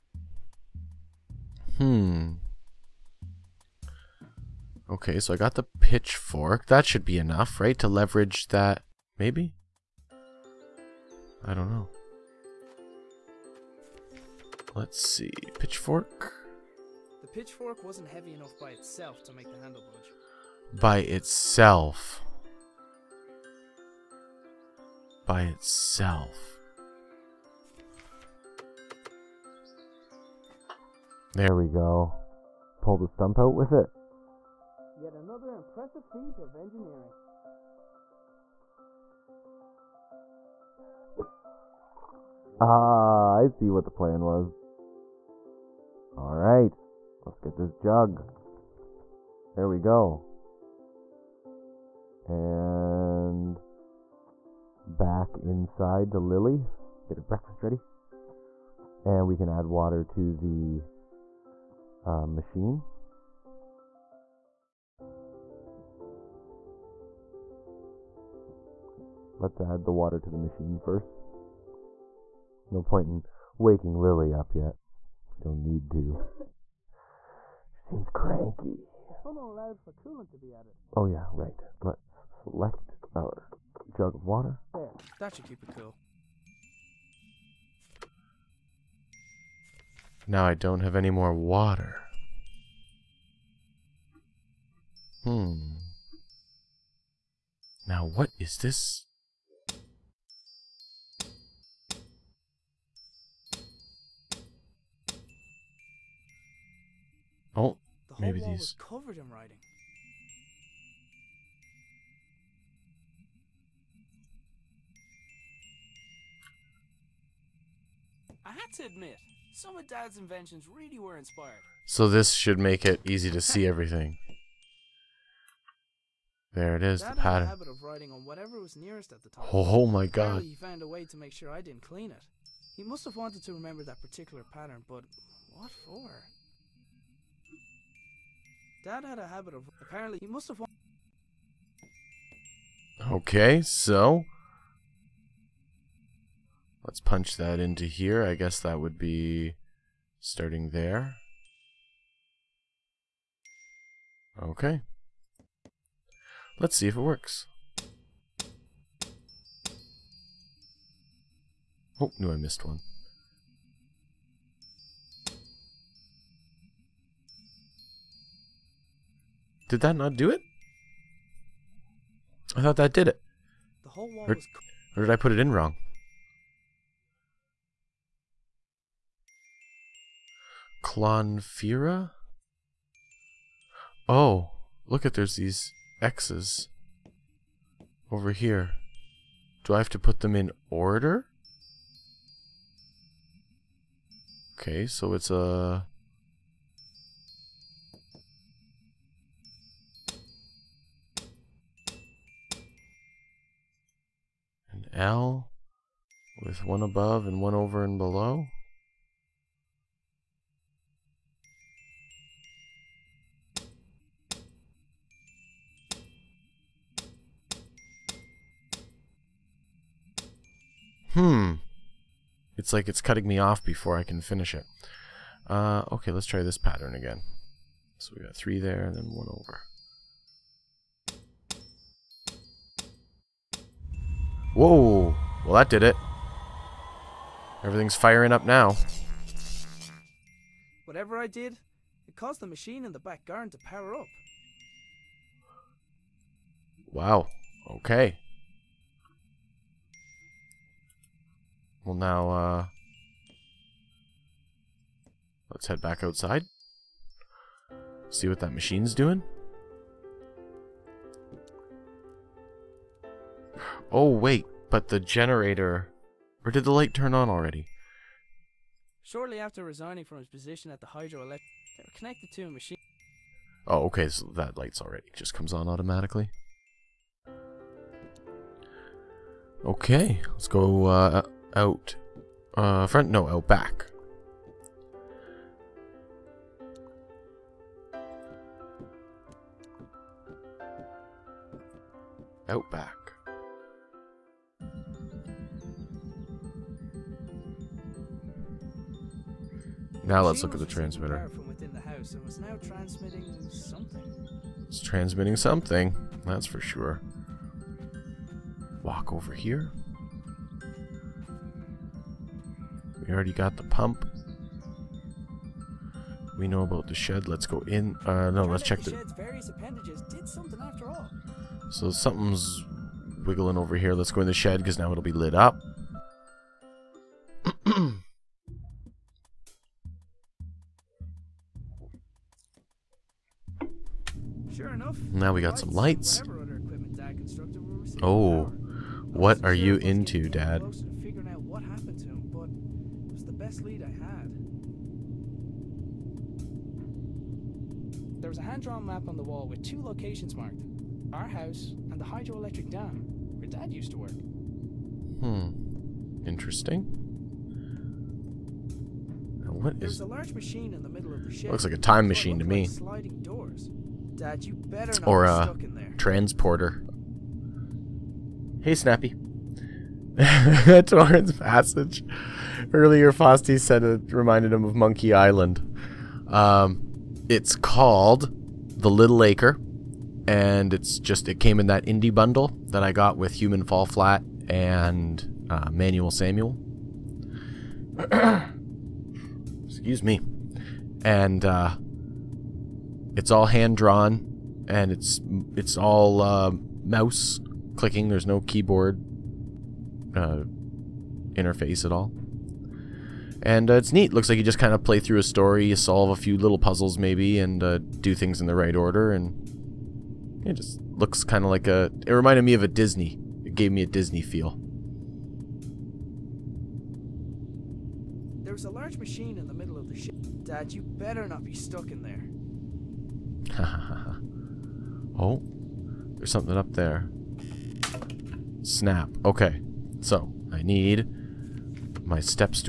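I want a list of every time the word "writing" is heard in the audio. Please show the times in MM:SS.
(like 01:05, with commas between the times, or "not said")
01:49, 02:07.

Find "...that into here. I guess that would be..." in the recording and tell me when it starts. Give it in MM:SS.
02:27.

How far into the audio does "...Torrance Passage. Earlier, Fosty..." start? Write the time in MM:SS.
06:10.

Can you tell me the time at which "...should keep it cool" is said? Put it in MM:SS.
01:25.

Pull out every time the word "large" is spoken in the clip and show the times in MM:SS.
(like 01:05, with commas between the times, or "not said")
06:00, 06:58.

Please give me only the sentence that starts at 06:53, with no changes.
It gave me a Disney feel.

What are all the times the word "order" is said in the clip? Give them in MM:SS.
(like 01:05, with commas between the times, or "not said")
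03:10, 06:48.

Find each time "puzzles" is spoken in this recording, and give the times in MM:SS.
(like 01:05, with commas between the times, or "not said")
06:46.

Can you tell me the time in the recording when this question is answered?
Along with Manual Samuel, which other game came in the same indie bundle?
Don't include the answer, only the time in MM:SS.
06:23.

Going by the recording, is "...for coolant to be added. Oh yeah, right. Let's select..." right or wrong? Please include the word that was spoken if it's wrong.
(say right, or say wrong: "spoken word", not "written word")
right.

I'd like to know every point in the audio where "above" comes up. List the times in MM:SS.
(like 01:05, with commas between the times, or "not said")
03:26.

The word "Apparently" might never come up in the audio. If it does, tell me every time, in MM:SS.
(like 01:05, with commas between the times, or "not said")
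02:10, 02:19.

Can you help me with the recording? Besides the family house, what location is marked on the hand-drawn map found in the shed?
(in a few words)
Hydroelectric dam.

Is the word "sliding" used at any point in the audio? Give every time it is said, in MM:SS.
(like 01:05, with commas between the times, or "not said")
06:02.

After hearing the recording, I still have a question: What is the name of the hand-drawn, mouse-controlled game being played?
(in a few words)
The Little Acre.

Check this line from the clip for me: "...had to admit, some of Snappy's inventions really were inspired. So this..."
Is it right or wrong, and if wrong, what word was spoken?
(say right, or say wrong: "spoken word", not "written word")
wrong: "Dad", not "Snappy".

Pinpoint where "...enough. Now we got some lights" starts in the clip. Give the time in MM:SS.
05:34.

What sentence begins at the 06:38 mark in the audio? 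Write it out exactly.
There's no keyboard uh, interface at all.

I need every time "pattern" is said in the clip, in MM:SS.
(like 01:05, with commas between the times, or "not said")
02:07, 02:14, 03:46.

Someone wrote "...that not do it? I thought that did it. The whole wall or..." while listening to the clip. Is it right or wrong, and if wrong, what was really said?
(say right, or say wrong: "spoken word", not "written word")
right.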